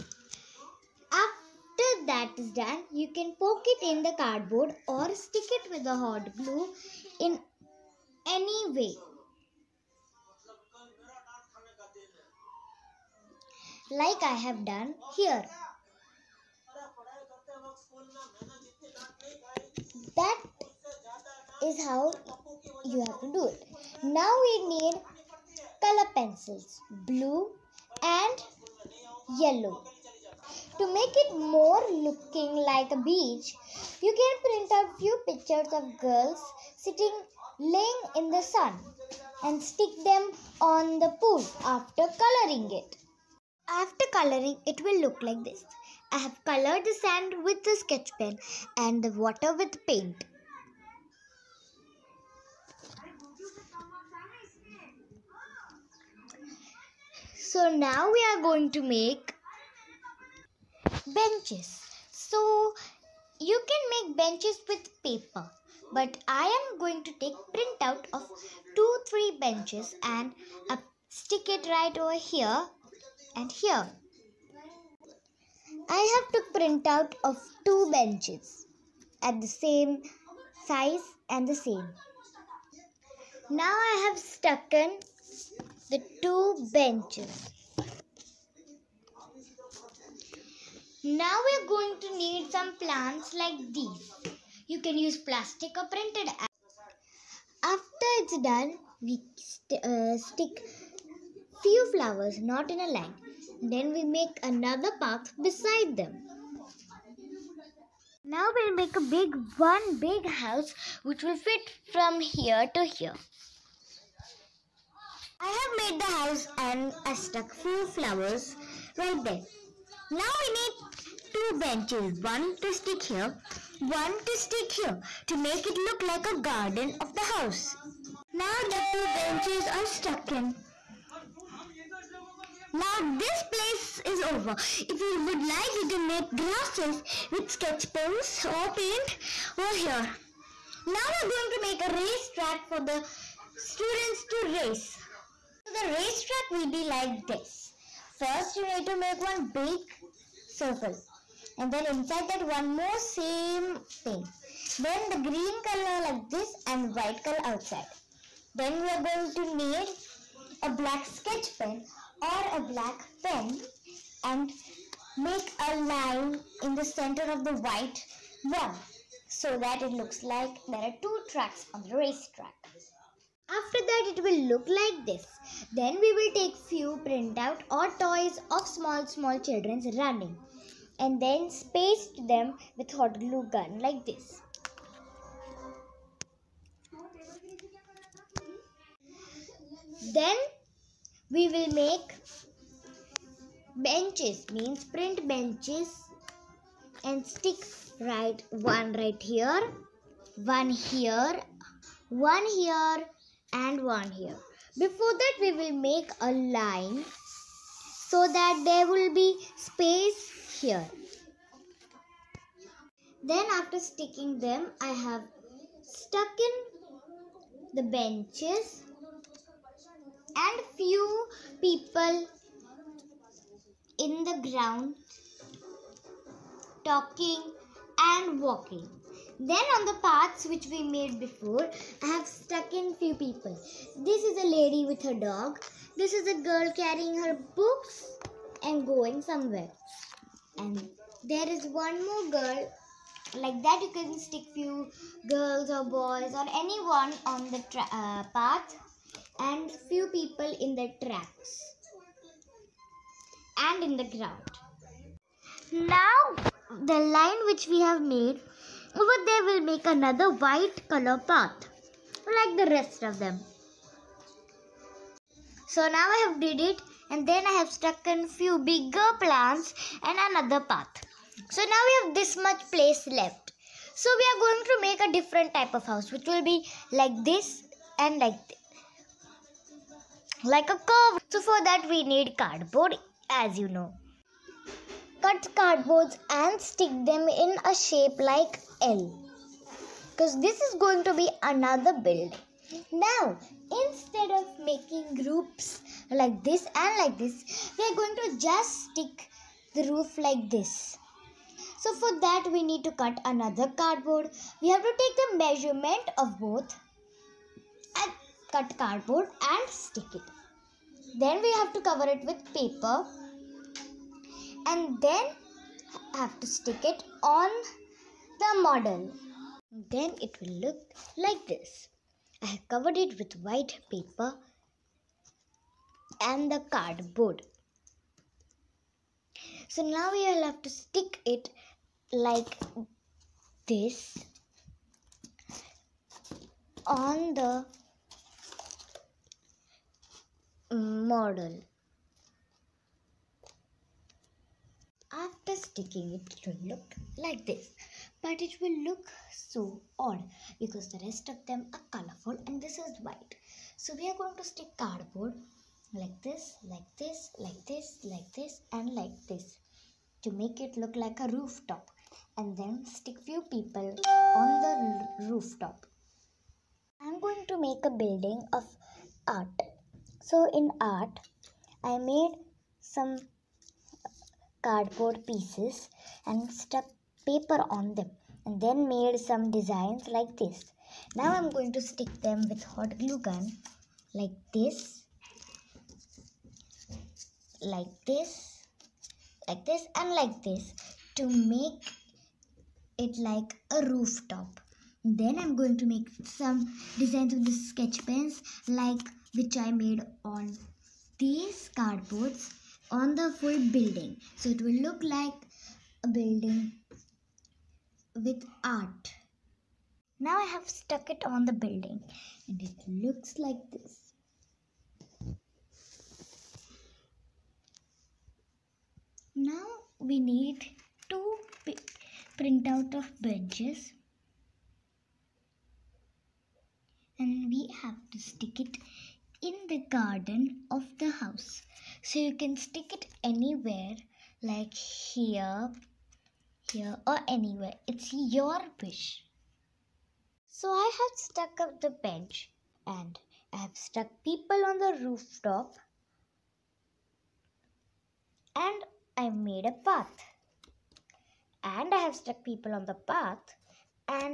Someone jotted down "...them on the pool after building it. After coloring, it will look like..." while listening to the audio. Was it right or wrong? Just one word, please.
wrong.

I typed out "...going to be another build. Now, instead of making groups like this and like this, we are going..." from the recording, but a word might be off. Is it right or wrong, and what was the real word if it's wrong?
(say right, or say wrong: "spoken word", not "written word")
right.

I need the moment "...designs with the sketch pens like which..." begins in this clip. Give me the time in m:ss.
6:36.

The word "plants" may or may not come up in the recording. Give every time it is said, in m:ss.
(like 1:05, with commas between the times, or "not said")
1:32, 4:29.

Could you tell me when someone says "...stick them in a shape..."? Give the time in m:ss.
4:46.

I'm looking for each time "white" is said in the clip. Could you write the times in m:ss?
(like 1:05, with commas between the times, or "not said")
2:36, 2:47, 4:20, 5:23, 5:53.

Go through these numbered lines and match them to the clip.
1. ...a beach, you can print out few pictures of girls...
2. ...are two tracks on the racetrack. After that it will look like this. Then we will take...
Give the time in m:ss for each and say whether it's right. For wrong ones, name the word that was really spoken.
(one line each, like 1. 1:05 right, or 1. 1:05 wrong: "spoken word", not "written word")
1. 0:32 right
2. 2:50 right.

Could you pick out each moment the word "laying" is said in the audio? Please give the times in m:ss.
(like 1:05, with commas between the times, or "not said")
0:37.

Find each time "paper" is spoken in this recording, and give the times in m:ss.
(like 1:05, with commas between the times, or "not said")
1:05, 5:12, 5:23, 6:17.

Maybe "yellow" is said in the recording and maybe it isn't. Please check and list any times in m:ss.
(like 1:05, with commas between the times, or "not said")
0:29.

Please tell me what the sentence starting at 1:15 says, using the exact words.
I have to print out of two benches at the same size and the same.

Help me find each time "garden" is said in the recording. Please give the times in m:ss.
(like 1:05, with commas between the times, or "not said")
2:06, 7:09.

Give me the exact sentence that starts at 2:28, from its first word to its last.
First you need to make one big circle and then inside that one more same thing.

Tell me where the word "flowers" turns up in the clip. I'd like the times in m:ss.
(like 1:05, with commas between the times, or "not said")
1:41, 1:57.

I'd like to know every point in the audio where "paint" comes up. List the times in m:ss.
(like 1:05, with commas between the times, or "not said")
0:49, 2:18.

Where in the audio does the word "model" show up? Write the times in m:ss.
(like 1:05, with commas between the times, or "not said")
5:18, 5:40.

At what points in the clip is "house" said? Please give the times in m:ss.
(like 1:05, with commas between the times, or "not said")
1:50, 1:56, 2:07, 4:35, 7:11.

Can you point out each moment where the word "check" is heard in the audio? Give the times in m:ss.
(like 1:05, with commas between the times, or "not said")
not said.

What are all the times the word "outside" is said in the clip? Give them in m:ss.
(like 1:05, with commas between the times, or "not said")
2:37.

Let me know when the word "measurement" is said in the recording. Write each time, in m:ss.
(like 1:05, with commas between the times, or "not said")
5:05.